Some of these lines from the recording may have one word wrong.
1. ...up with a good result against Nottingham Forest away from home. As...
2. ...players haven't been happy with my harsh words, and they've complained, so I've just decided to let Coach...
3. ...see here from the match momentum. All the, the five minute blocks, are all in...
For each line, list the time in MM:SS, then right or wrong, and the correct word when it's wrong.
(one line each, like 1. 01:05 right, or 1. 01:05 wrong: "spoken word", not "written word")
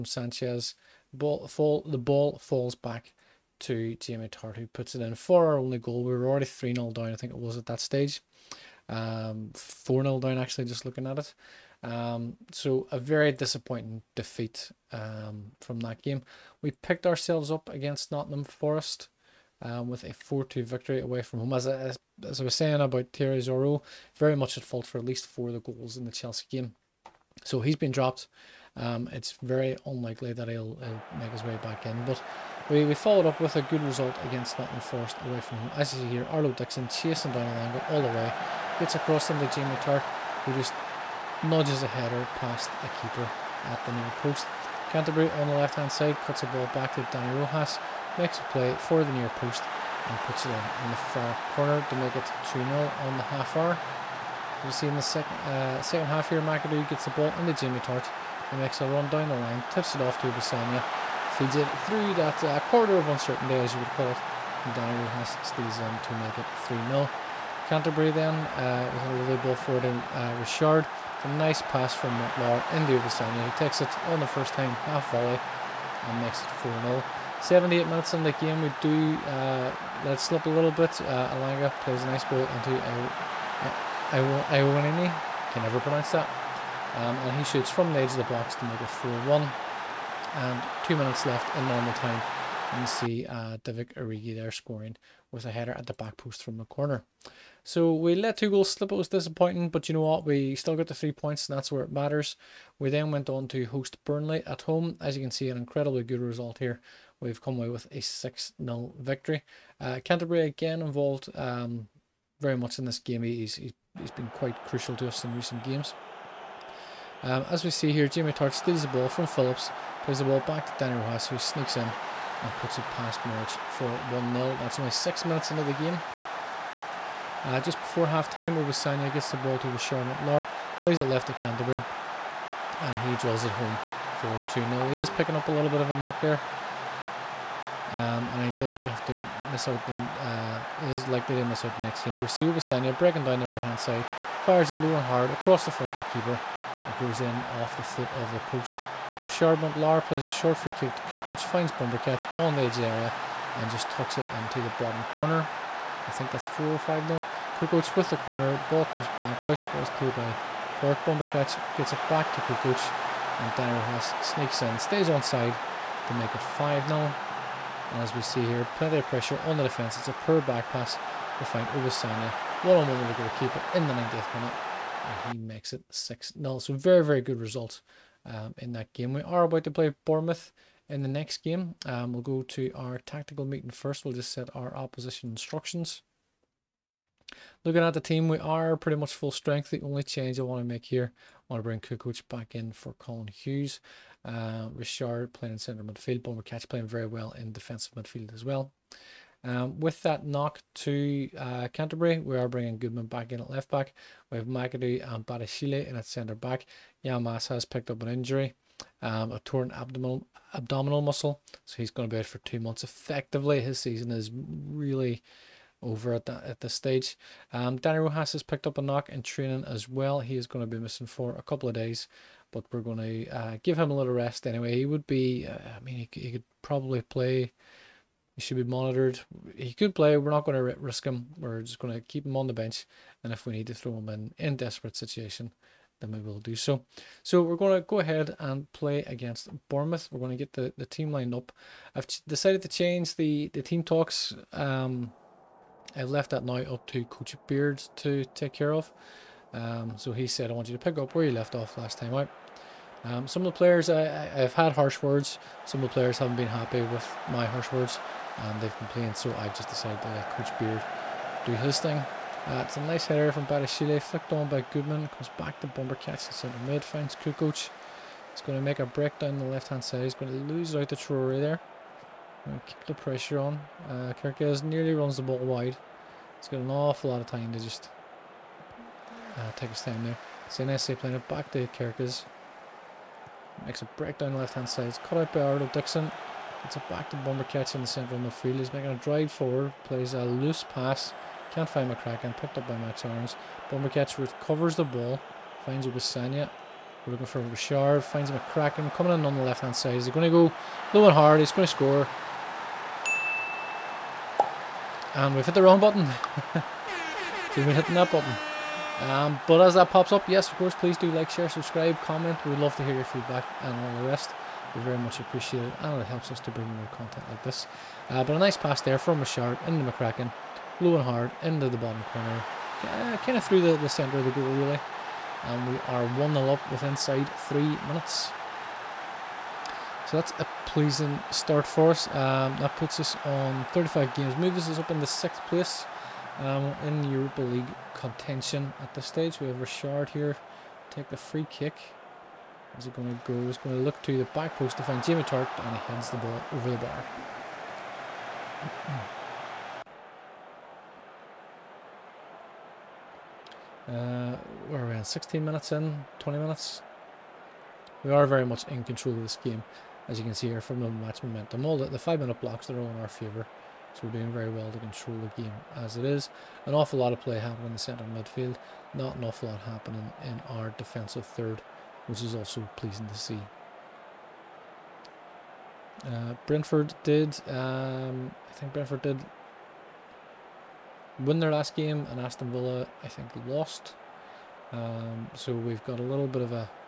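1. 00:33 right
2. 04:15 right
3. 06:00 right.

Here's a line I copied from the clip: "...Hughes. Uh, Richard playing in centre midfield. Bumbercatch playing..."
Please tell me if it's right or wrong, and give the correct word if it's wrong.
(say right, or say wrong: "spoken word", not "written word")
right.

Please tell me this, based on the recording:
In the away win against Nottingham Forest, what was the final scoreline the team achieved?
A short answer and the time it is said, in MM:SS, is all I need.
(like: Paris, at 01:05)
4-2, at 00:20.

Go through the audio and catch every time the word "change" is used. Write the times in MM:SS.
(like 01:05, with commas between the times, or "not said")
03:10, 04:02.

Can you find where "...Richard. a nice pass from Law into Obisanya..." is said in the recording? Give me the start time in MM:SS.
01:10.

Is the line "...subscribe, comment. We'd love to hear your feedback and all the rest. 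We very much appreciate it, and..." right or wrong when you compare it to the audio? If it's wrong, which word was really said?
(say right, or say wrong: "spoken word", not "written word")
right.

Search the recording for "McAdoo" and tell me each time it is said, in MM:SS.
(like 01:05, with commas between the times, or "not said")
00:56, 03:24.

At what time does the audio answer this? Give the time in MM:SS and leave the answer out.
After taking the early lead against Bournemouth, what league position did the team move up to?
05:35.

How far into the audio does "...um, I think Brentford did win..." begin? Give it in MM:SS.
06:17.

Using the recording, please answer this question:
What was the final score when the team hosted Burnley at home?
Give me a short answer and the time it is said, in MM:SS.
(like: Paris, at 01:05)
6-0, at 01:48.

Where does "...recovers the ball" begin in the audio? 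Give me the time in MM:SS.
04:54.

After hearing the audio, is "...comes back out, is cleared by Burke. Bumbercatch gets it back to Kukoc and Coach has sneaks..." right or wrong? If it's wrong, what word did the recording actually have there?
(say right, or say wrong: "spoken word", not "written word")
wrong: "Dyer", not "Coach".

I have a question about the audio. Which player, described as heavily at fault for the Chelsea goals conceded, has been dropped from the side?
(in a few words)
Thierry Zoreaux.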